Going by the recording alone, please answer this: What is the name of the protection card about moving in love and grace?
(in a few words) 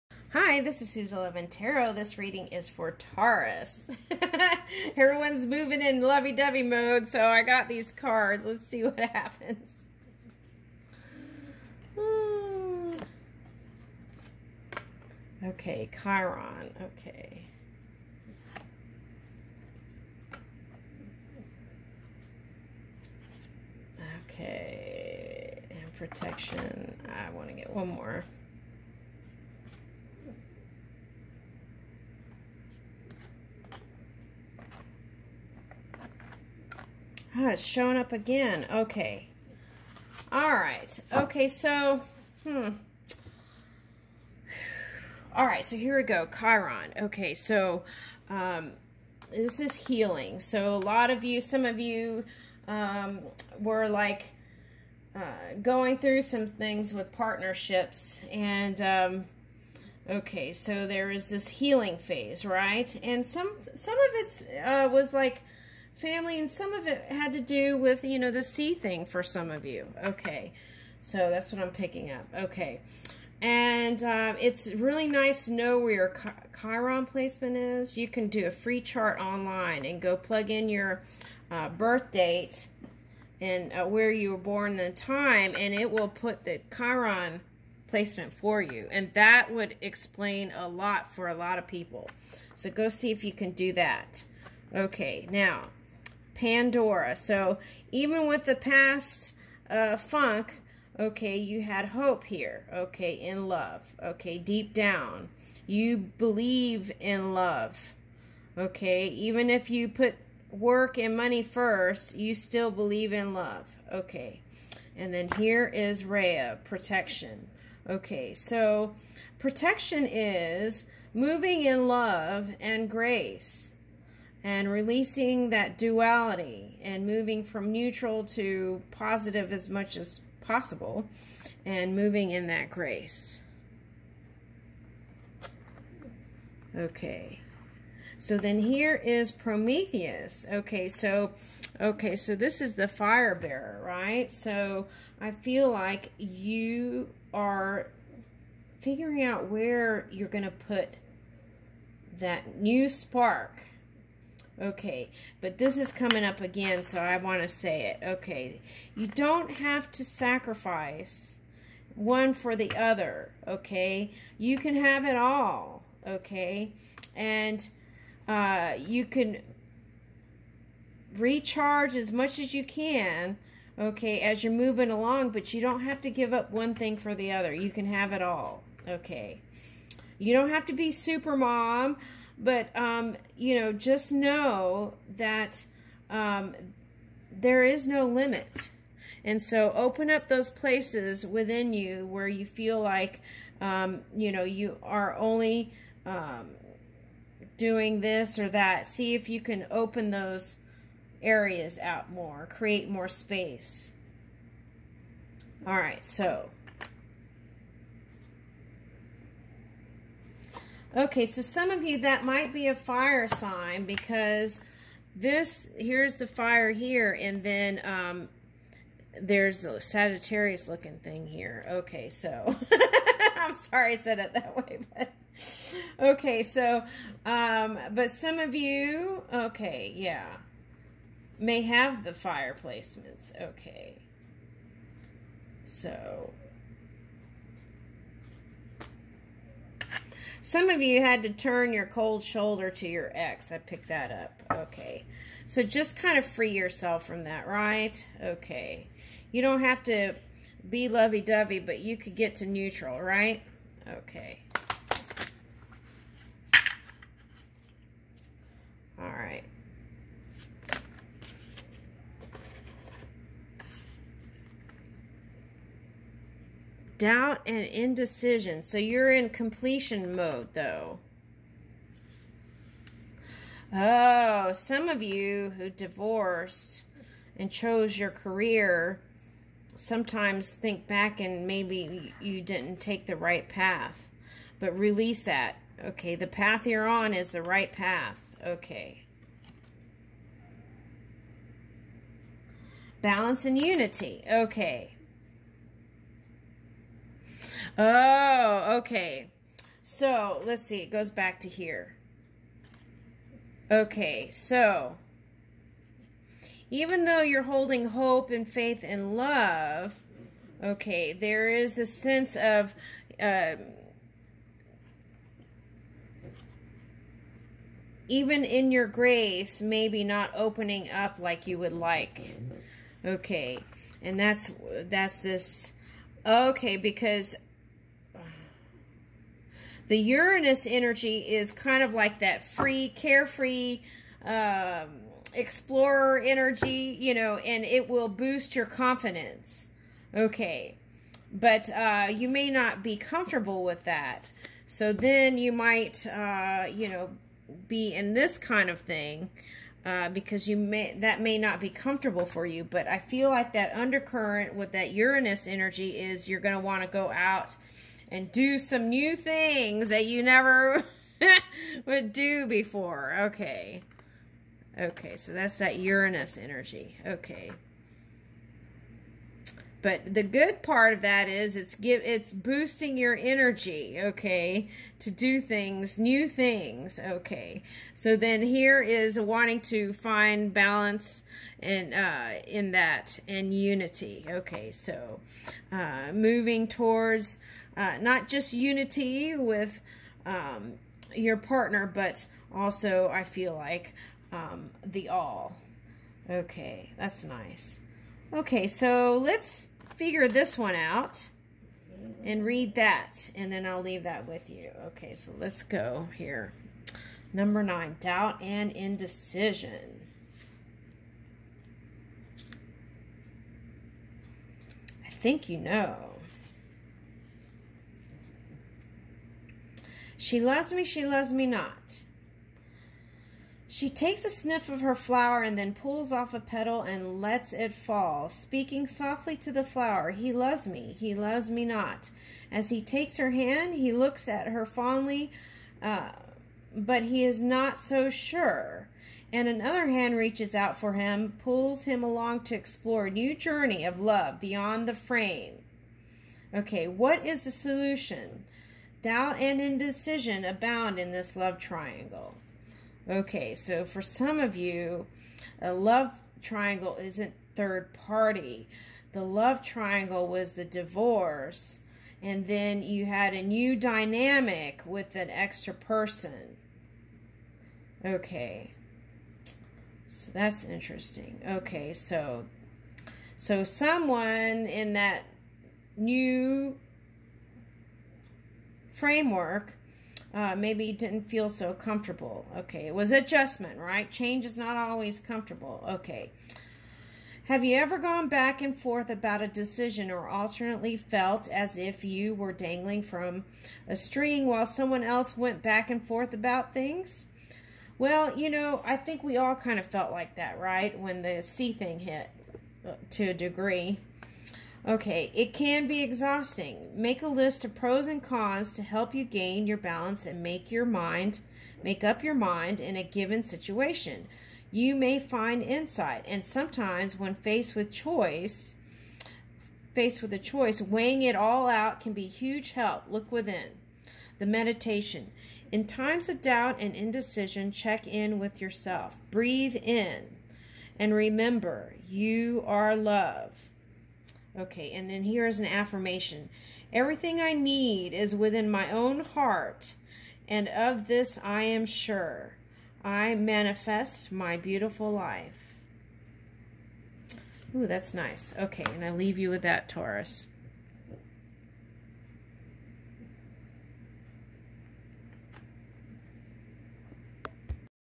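Rhea.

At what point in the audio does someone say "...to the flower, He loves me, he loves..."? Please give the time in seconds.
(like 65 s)
429 s.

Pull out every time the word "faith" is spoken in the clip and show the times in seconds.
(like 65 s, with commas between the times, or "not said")
308 s.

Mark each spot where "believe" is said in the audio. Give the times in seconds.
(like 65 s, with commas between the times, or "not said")
106 s, 112 s.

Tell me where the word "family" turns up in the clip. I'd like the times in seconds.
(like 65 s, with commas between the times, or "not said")
66 s.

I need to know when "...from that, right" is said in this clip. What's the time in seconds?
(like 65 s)
247 s.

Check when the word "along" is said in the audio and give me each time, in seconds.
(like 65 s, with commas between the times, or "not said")
174 s, 442 s.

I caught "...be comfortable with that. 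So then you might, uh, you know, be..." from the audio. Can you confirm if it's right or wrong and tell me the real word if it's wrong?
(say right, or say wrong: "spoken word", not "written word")
right.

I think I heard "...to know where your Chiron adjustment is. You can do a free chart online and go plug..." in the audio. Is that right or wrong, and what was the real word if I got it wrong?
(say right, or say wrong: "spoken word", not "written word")
wrong: "placement", not "adjustment".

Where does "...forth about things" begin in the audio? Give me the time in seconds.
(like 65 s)
496 s.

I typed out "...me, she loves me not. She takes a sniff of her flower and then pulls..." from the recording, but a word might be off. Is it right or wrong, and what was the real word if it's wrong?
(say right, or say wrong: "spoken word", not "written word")
right.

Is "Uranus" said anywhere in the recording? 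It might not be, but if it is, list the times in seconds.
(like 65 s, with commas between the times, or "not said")
329 s, 354 s, 365 s.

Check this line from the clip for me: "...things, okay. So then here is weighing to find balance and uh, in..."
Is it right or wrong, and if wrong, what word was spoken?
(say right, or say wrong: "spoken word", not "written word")
wrong: "wanting", not "weighing".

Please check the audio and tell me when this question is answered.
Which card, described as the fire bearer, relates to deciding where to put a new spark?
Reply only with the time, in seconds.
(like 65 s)
139 s.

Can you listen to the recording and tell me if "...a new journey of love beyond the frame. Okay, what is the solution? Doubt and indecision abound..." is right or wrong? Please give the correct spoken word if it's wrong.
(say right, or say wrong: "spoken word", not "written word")
right.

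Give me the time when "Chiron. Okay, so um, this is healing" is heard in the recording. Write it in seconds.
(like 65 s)
46 s.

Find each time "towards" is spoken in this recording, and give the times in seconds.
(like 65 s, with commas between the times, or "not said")
386 s.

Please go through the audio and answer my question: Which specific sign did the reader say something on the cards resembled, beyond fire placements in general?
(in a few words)
Sagittarius.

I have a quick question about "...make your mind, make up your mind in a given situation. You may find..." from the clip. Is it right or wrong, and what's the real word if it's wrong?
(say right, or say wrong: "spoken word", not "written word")
right.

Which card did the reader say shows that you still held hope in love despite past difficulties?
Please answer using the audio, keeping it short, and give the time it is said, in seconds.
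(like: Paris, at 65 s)
Pandora, at 96 s.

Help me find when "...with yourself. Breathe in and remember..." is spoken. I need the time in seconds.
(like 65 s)
528 s.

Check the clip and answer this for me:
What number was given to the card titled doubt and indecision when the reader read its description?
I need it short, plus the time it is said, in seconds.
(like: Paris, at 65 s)
9, at 407 s.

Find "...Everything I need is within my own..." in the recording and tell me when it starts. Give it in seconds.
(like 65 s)
536 s.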